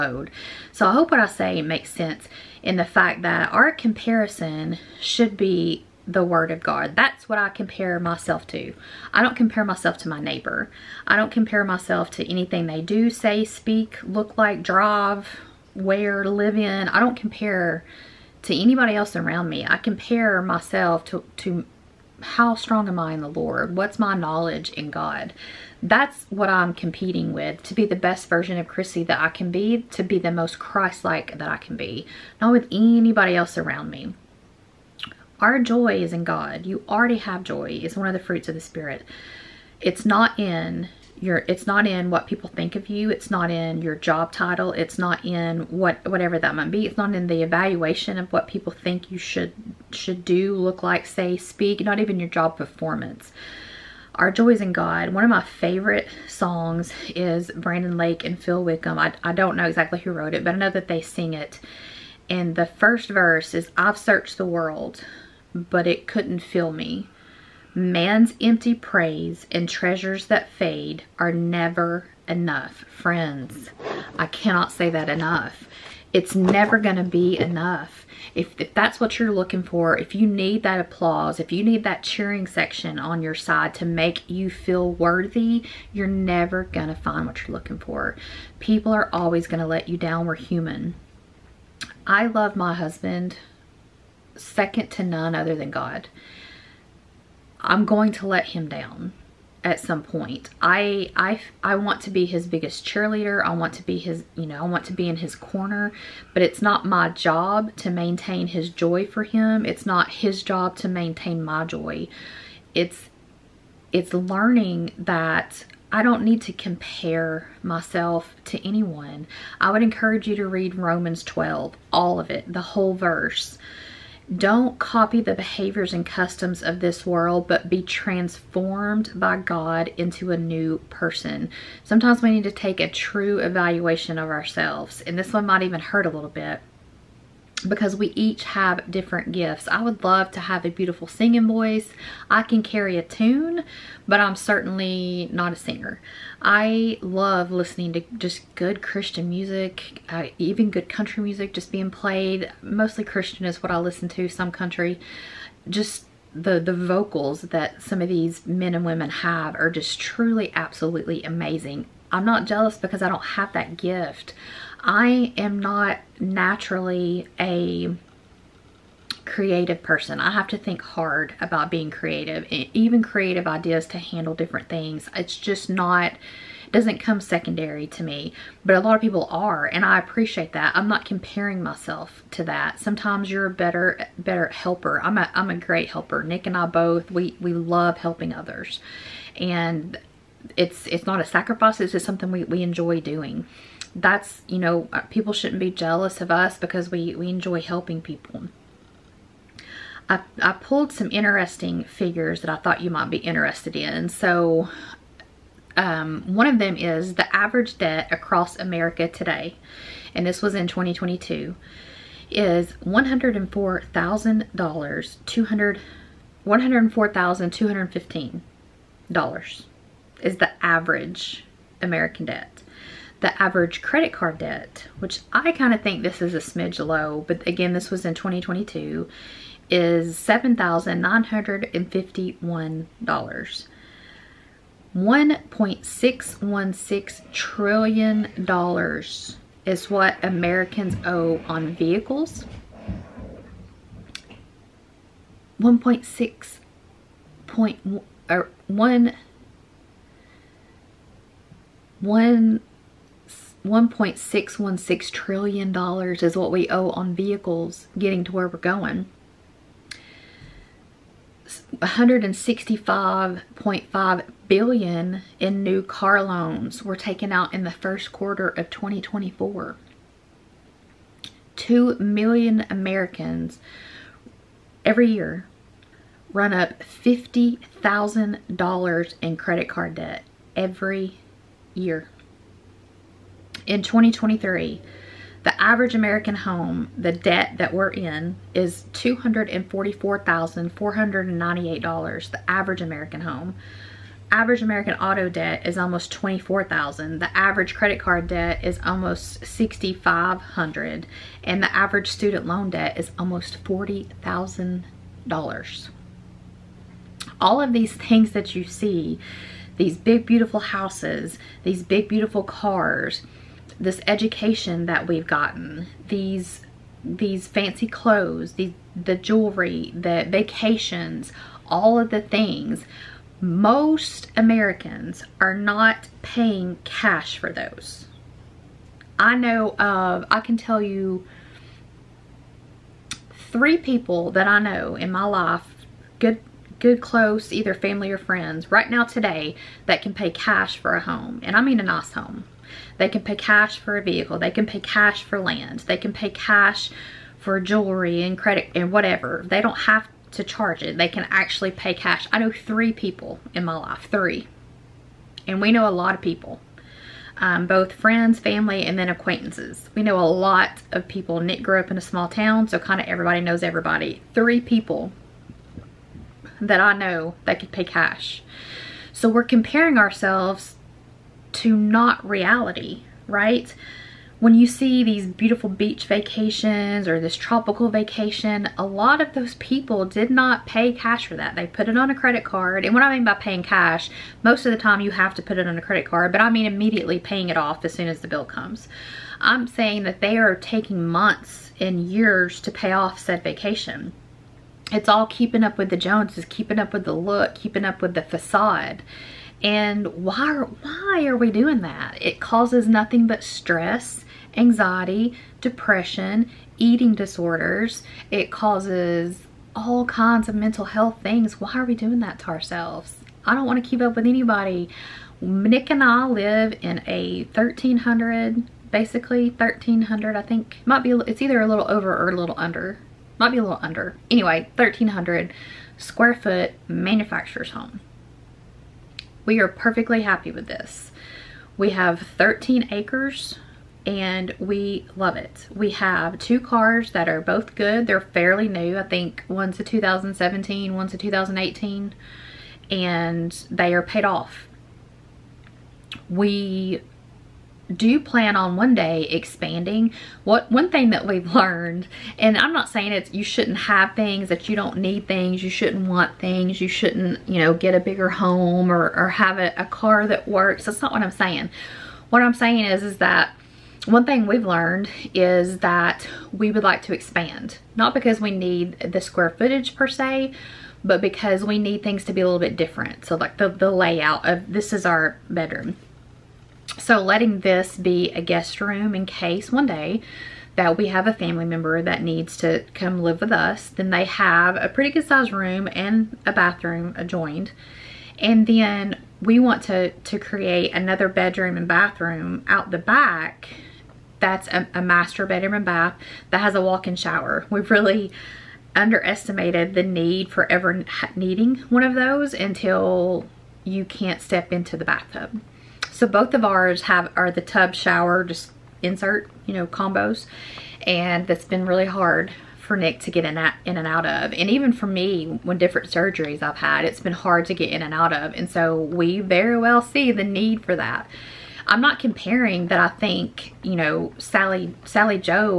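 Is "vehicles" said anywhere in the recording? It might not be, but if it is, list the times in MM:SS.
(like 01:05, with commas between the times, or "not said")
04:01, 04:17, 05:44.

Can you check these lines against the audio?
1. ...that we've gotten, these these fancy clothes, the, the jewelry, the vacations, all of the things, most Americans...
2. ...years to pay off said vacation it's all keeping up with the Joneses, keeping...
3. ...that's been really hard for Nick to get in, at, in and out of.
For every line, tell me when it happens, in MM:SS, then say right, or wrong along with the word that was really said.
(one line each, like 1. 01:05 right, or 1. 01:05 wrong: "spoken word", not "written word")
1. 05:14 right
2. 06:32 right
3. 08:31 right.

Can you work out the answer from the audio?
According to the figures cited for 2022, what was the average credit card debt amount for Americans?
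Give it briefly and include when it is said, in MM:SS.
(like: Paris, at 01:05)
$7,951, at 03:50.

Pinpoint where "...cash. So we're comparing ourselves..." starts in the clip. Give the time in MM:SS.
06:07.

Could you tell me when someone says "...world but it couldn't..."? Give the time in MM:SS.
01:04.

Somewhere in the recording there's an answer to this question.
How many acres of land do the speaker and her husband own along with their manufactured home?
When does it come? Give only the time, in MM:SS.
07:12.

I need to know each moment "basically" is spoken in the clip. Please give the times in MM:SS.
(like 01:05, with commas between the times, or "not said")
06:58.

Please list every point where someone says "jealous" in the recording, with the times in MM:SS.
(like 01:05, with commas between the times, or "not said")
02:42, 03:15.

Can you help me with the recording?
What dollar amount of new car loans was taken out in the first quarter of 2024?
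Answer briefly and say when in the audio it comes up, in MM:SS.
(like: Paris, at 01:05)
165.5 billion, at 04:21.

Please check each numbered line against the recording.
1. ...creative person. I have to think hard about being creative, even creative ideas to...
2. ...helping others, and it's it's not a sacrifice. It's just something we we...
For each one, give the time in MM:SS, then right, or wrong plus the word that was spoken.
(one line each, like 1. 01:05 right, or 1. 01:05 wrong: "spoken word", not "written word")
1. 02:49 right
2. 03:07 right.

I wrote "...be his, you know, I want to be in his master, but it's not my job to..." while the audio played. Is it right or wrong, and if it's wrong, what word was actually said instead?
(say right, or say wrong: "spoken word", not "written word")
wrong: "corner", not "master".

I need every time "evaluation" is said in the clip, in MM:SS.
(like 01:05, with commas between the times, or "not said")
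00:47, 02:13.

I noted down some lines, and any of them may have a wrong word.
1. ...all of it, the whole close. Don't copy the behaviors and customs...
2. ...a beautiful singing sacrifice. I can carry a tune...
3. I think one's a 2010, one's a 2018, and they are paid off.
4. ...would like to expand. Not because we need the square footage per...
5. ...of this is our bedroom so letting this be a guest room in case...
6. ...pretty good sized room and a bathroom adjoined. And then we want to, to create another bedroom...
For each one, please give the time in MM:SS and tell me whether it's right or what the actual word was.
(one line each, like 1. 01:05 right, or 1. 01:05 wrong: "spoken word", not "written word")
1. 02:01 wrong: "verse", not "close"
2. 02:20 wrong: "voice", not "sacrifice"
3. 07:18 wrong: "2017", not "2010"
4. 07:46 right
5. 07:54 right
6. 08:04 right.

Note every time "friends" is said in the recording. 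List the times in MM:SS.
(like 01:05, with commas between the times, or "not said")
01:12, 05:38, 05:57.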